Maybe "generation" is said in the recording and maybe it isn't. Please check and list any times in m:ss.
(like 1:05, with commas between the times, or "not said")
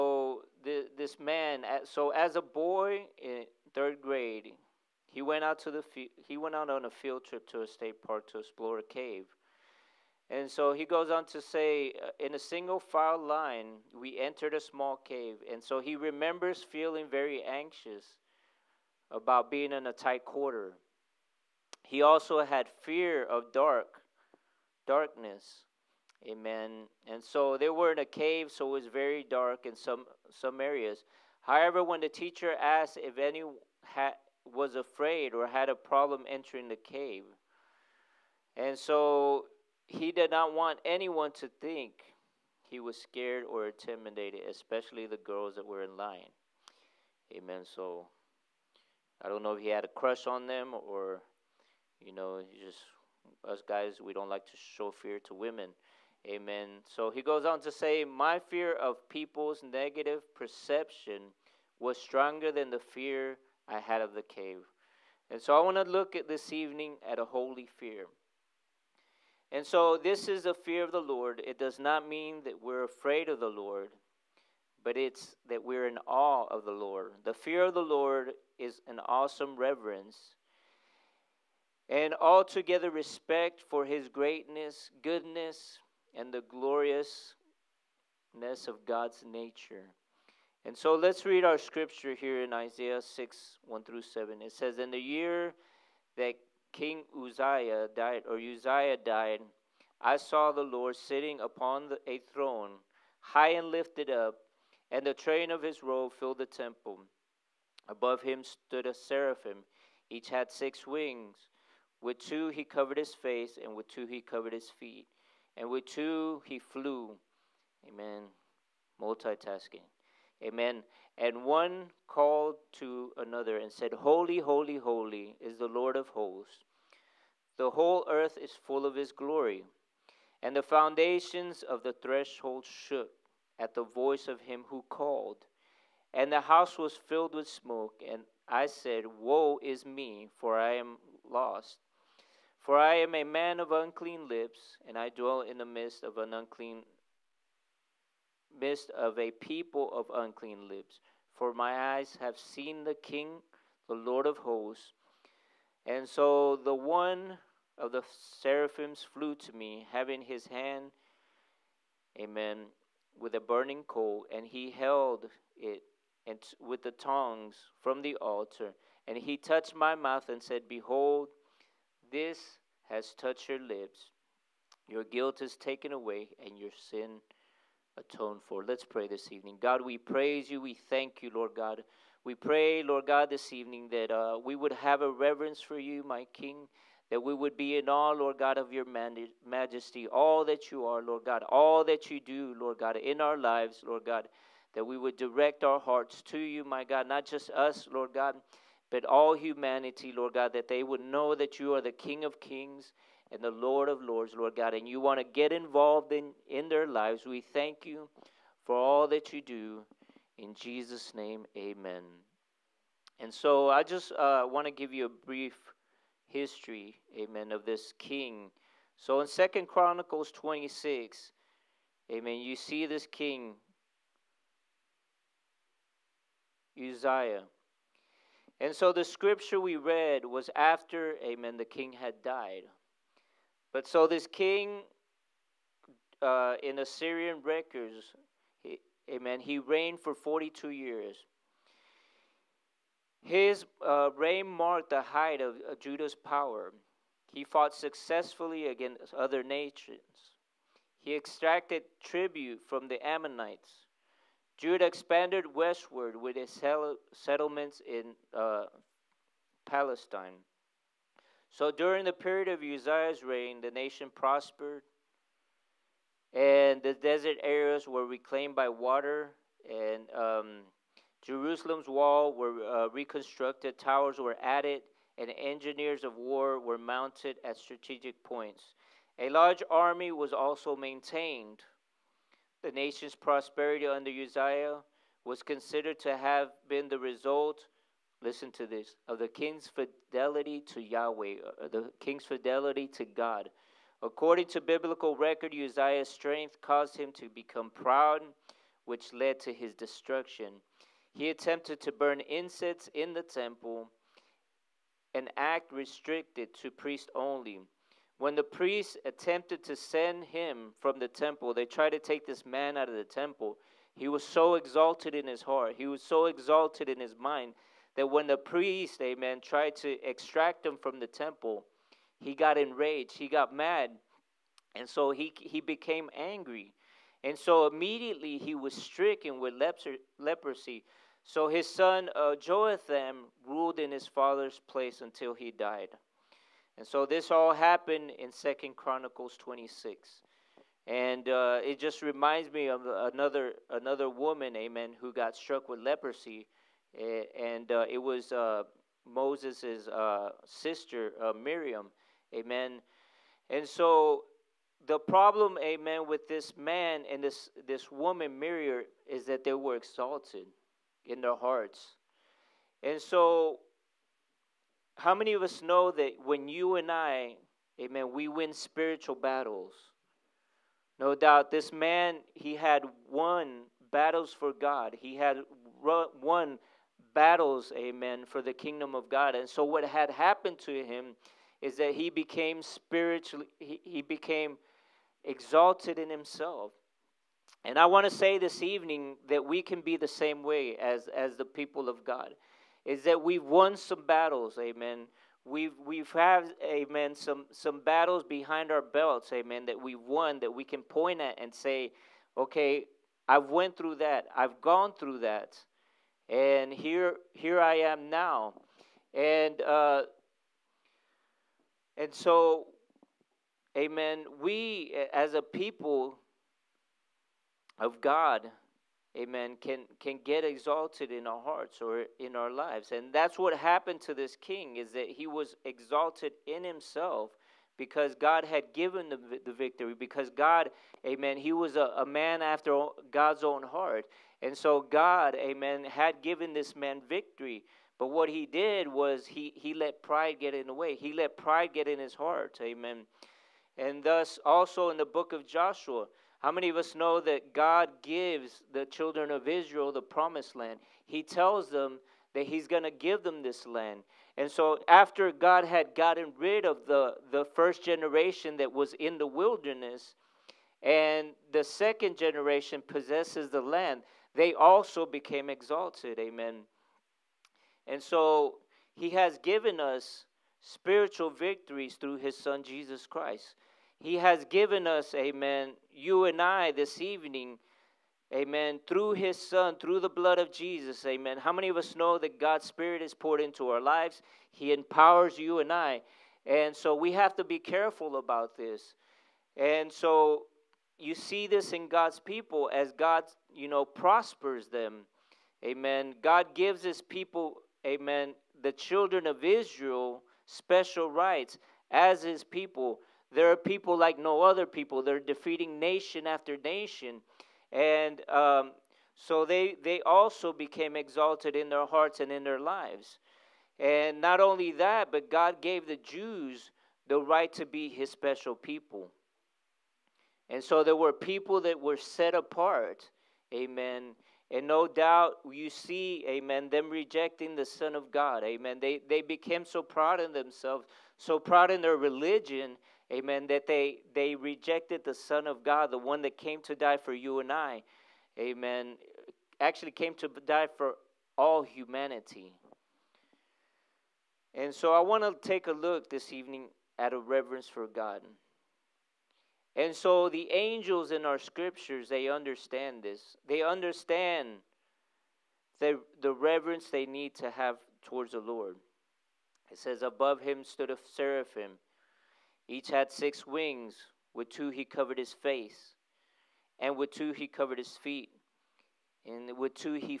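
7:37, 7:42.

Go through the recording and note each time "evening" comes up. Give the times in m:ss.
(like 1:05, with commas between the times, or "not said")
1:06, 2:59, 3:03, 6:28, 7:56, 9:06.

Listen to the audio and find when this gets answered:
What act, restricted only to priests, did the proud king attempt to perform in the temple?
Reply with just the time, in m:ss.
5:01.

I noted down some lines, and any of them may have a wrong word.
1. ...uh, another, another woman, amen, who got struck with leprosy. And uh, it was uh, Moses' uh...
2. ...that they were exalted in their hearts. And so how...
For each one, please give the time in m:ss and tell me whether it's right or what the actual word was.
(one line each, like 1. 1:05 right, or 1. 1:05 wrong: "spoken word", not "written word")
1. 5:42 right
2. 5:59 right.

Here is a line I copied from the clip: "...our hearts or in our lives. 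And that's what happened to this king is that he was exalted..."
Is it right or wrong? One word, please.
right.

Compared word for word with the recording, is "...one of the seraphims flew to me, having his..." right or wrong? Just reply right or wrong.
right.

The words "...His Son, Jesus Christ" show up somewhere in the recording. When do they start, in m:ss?
7:52.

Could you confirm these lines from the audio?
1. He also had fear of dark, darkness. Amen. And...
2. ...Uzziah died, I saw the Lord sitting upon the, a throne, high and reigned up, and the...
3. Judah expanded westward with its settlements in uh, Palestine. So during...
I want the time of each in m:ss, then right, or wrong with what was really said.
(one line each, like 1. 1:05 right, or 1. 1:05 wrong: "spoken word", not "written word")
1. 0:21 right
2. 1:38 wrong: "lifted", not "reigned"
3. 4:14 right.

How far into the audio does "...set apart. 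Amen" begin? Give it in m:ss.
8:41.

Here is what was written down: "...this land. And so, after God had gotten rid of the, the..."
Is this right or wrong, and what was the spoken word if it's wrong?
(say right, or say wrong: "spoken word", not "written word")
right.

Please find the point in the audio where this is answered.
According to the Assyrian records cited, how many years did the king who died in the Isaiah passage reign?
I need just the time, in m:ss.
4:00.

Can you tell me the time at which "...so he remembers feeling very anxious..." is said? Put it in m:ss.
0:15.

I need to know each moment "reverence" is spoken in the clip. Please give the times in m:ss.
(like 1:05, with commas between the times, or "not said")
1:19, 3:05, 9:07, 9:16.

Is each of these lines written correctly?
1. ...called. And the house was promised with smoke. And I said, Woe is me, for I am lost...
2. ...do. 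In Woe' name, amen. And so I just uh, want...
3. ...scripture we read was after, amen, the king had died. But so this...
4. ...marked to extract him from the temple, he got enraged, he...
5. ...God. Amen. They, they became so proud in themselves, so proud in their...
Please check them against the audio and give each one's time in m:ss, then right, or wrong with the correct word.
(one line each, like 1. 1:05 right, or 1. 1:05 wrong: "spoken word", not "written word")
1. 2:14 wrong: "filled", not "promised"
2. 3:29 wrong: "Jesus", not "Woe"
3. 3:49 right
4. 5:19 wrong: "tried", not "marked"
5. 8:48 right.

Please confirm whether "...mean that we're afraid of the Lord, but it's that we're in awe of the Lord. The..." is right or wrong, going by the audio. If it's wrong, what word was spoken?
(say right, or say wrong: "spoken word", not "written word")
right.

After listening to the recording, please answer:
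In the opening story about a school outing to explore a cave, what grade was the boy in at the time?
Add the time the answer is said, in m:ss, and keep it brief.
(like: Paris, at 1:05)
third grade, at 0:03.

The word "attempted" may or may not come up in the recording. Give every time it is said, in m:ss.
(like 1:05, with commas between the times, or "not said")
5:01, 5:09.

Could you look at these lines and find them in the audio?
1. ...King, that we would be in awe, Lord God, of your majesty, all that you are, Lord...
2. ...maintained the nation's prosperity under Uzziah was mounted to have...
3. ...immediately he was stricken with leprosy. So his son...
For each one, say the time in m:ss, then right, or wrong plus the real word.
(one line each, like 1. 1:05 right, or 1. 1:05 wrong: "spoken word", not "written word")
1. 3:06 right
2. 4:40 wrong: "considered", not "mounted"
3. 5:27 right.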